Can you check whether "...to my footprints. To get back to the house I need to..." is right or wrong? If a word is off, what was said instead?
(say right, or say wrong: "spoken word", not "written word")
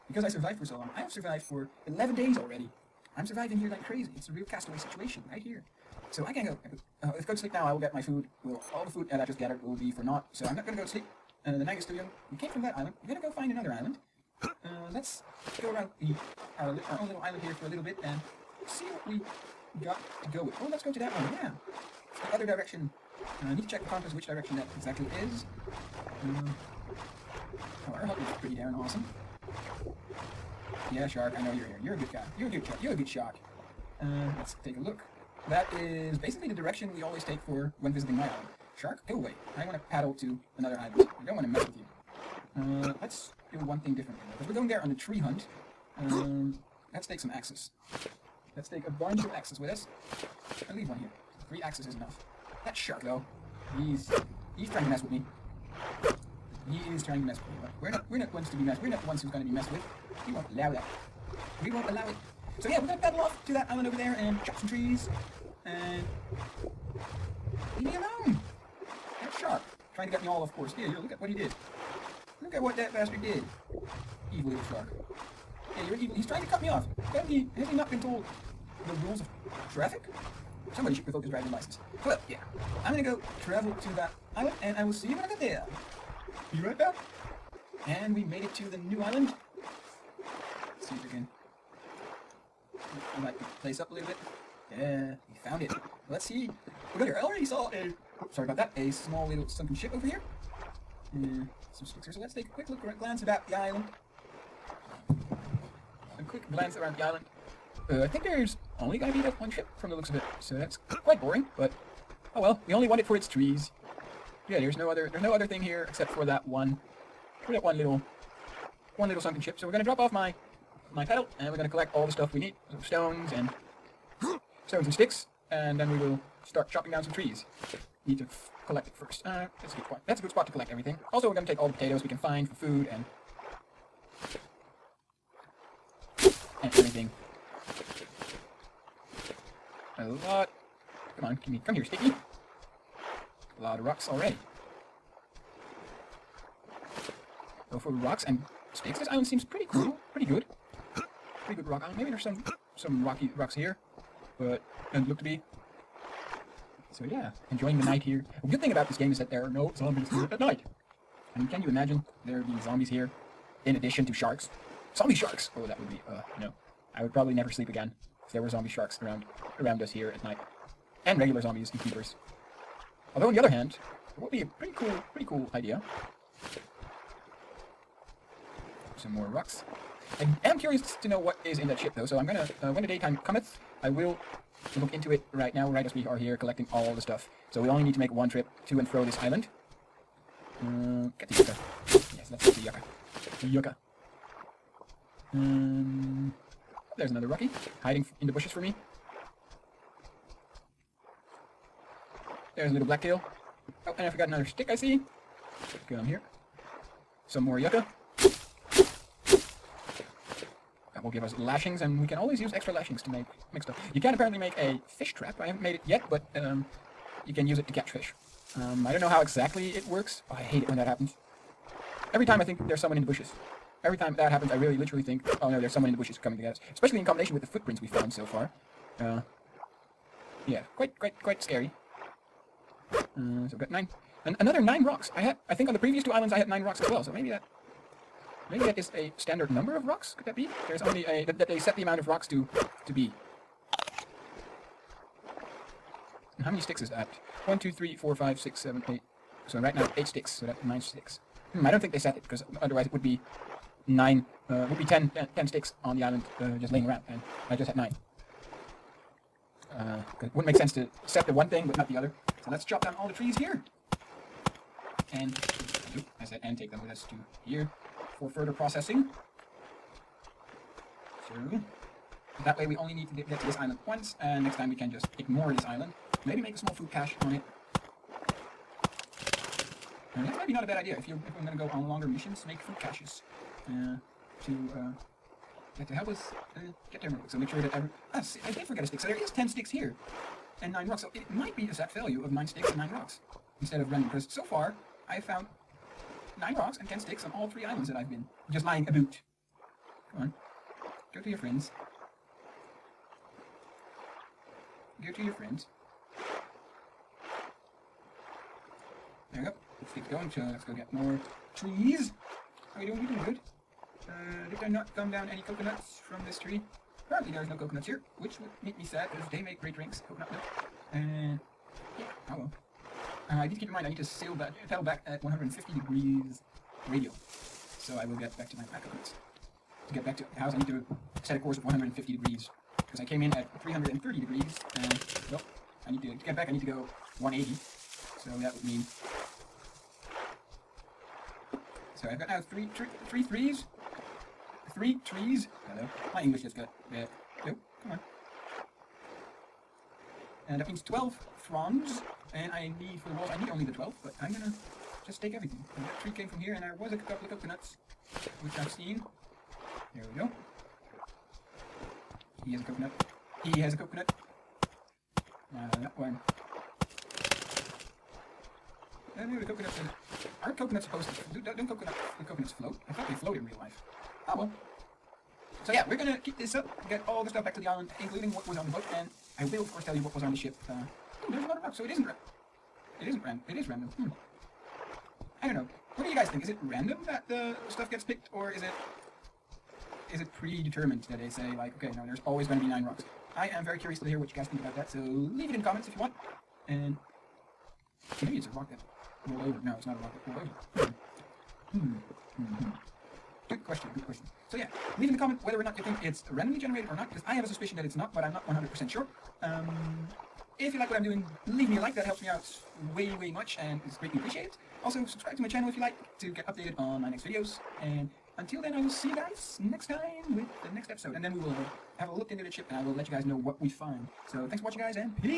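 wrong: "coconuts", not "footprints".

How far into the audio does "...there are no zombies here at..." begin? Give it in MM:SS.
02:39.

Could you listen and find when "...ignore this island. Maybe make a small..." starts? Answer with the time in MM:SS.
04:35.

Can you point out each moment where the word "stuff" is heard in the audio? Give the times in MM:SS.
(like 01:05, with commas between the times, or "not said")
02:02, 03:06, 03:33, 06:17, 06:27.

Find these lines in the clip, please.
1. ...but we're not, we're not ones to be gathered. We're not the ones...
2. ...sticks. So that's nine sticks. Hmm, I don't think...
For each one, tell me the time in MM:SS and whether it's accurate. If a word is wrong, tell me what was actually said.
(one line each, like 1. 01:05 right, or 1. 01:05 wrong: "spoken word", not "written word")
1. 00:57 wrong: "messed", not "gathered"
2. 04:10 right.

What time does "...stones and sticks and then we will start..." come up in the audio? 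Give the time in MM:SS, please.
02:04.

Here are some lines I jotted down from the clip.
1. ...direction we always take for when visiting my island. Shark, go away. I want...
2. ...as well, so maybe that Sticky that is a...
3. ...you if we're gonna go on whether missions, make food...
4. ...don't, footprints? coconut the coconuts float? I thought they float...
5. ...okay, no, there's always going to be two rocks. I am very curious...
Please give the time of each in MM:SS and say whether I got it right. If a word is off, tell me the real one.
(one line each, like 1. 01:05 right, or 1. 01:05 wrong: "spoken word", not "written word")
1. 00:36 right
2. 03:56 wrong: "Maybe", not "Sticky"
3. 04:41 wrong: "longer", not "whether"
4. 06:11 wrong: "coconuts", not "footprints"
5. 06:31 wrong: "nine", not "two".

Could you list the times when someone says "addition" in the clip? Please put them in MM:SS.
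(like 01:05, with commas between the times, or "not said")
02:43.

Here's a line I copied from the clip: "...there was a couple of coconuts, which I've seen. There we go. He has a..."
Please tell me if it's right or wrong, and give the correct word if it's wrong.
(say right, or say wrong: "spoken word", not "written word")
right.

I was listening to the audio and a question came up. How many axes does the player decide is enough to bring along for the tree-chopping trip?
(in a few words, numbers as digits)
3.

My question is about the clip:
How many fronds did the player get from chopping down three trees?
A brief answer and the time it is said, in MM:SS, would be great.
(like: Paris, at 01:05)
12, at 05:50.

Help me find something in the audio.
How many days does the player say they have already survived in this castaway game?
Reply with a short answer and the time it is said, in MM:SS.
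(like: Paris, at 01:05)
11, at 00:01.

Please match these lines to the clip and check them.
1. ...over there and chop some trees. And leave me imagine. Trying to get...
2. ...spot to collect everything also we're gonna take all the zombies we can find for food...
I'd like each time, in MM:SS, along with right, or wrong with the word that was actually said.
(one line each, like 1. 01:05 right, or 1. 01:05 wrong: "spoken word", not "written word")
1. 01:03 wrong: "alone", not "imagine"
2. 02:10 wrong: "potatoes", not "zombies".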